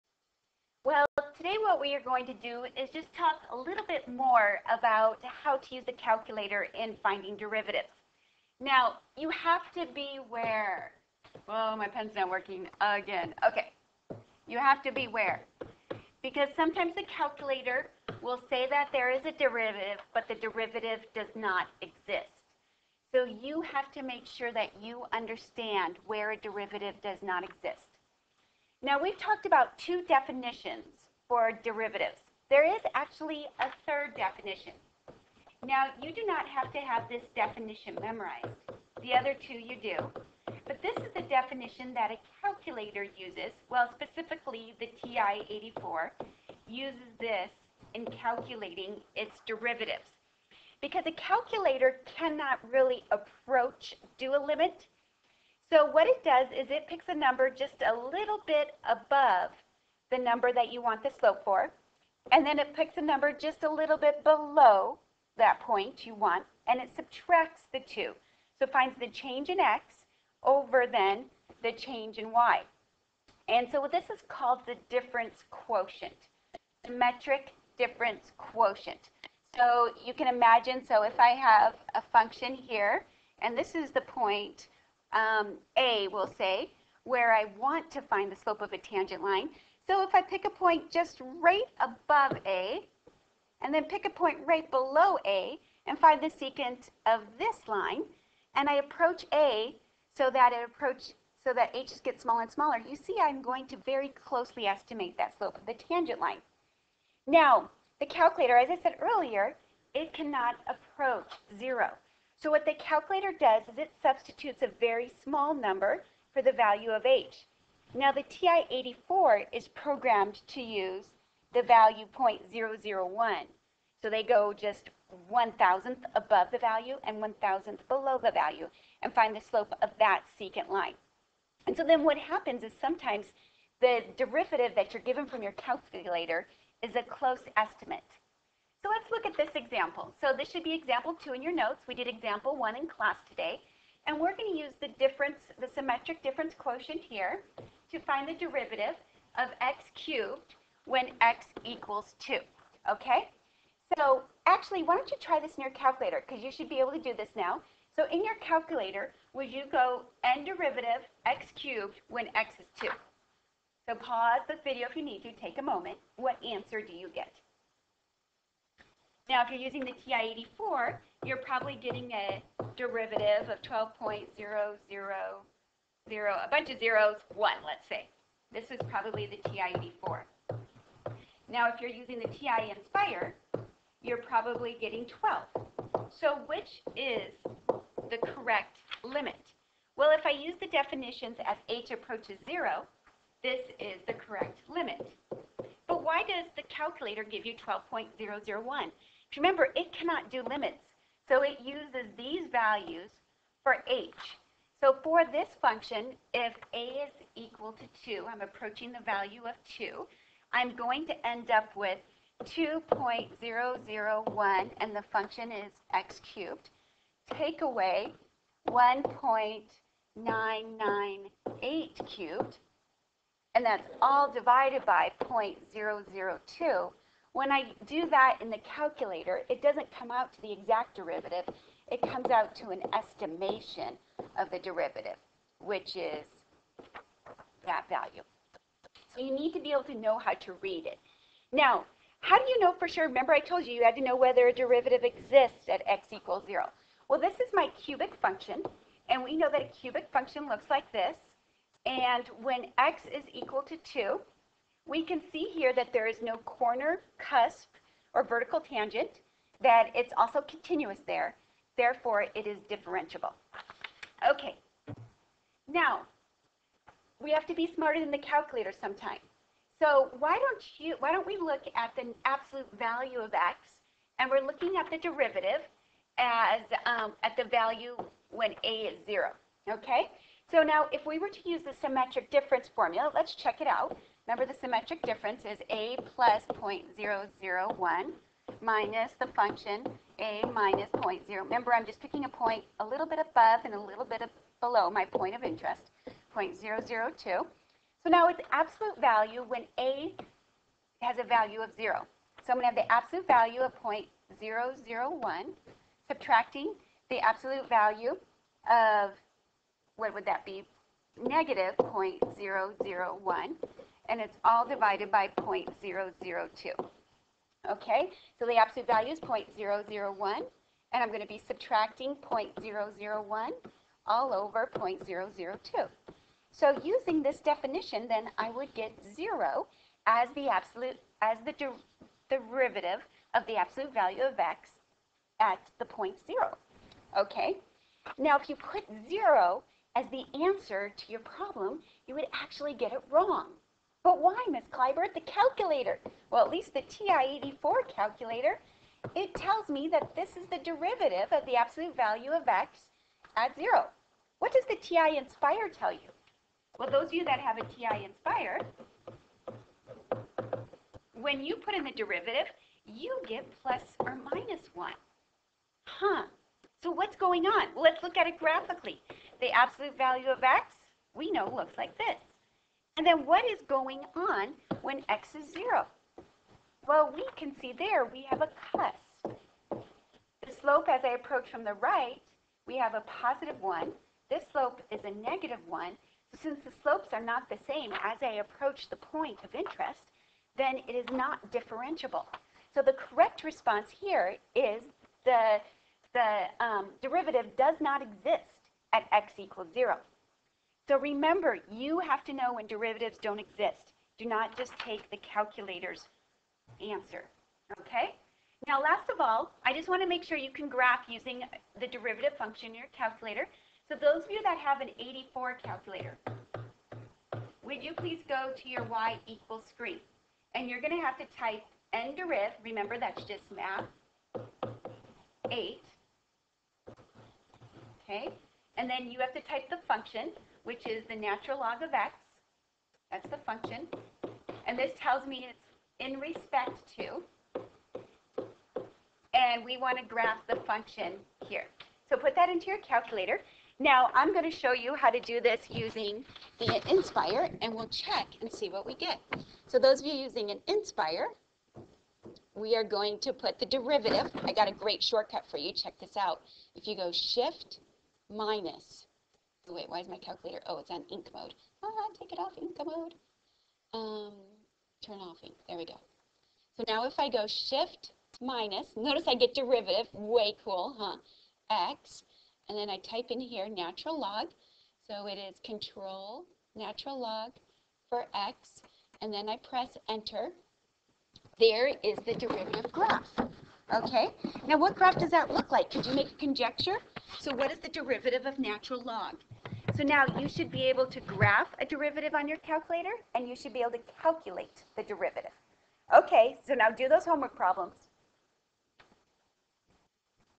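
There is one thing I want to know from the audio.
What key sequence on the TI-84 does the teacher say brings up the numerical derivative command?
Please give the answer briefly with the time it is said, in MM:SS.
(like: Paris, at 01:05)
math, 8, at 07:03.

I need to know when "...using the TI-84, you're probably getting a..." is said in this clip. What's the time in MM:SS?
02:49.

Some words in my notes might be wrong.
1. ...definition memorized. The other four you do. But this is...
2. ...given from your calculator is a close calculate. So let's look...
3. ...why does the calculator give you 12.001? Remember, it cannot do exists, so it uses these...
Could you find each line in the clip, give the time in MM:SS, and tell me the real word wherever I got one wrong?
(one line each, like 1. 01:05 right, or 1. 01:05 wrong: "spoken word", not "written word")
1. 00:37 wrong: "two", not "four"
2. 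02:15 wrong: "estimate", not "calculate"
3. 03:16 wrong: "limits", not "exists".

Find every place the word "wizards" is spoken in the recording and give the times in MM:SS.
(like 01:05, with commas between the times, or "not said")
not said.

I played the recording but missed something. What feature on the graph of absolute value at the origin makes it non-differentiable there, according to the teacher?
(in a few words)
a cusp.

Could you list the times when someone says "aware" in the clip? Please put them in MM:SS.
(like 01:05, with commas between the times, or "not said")
00:10, 00:15.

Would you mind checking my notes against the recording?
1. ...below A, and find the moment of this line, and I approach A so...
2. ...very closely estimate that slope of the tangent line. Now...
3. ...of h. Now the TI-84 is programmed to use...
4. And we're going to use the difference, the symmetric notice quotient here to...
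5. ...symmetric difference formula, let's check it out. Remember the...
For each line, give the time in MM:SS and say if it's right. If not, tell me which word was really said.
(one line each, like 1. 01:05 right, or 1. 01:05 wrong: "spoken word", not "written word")
1. 01:34 wrong: "secant", not "moment"
2. 01:43 right
3. 01:56 right
4. 02:24 wrong: "difference", not "notice"
5. 04:41 right.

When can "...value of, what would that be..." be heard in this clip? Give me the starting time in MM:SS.
05:07.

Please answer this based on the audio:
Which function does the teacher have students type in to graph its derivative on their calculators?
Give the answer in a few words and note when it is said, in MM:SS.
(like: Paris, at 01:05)
natural log of x, at 07:11.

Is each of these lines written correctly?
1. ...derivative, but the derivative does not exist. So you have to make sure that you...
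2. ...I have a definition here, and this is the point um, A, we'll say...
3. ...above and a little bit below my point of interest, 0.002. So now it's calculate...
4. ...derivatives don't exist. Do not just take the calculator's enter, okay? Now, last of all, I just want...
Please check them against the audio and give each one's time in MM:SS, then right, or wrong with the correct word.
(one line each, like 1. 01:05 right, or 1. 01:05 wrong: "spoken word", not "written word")
1. 00:19 right
2. 01:21 wrong: "function", not "definition"
3. 04:53 wrong: "absolute", not "calculate"
4. 06:42 wrong: "answer", not "enter".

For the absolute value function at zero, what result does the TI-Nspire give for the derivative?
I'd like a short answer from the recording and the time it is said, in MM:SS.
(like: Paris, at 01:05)
plus or minus 1, at 06:03.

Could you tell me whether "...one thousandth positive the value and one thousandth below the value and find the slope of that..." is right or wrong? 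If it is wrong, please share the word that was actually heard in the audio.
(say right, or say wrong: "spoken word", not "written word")
wrong: "above", not "positive".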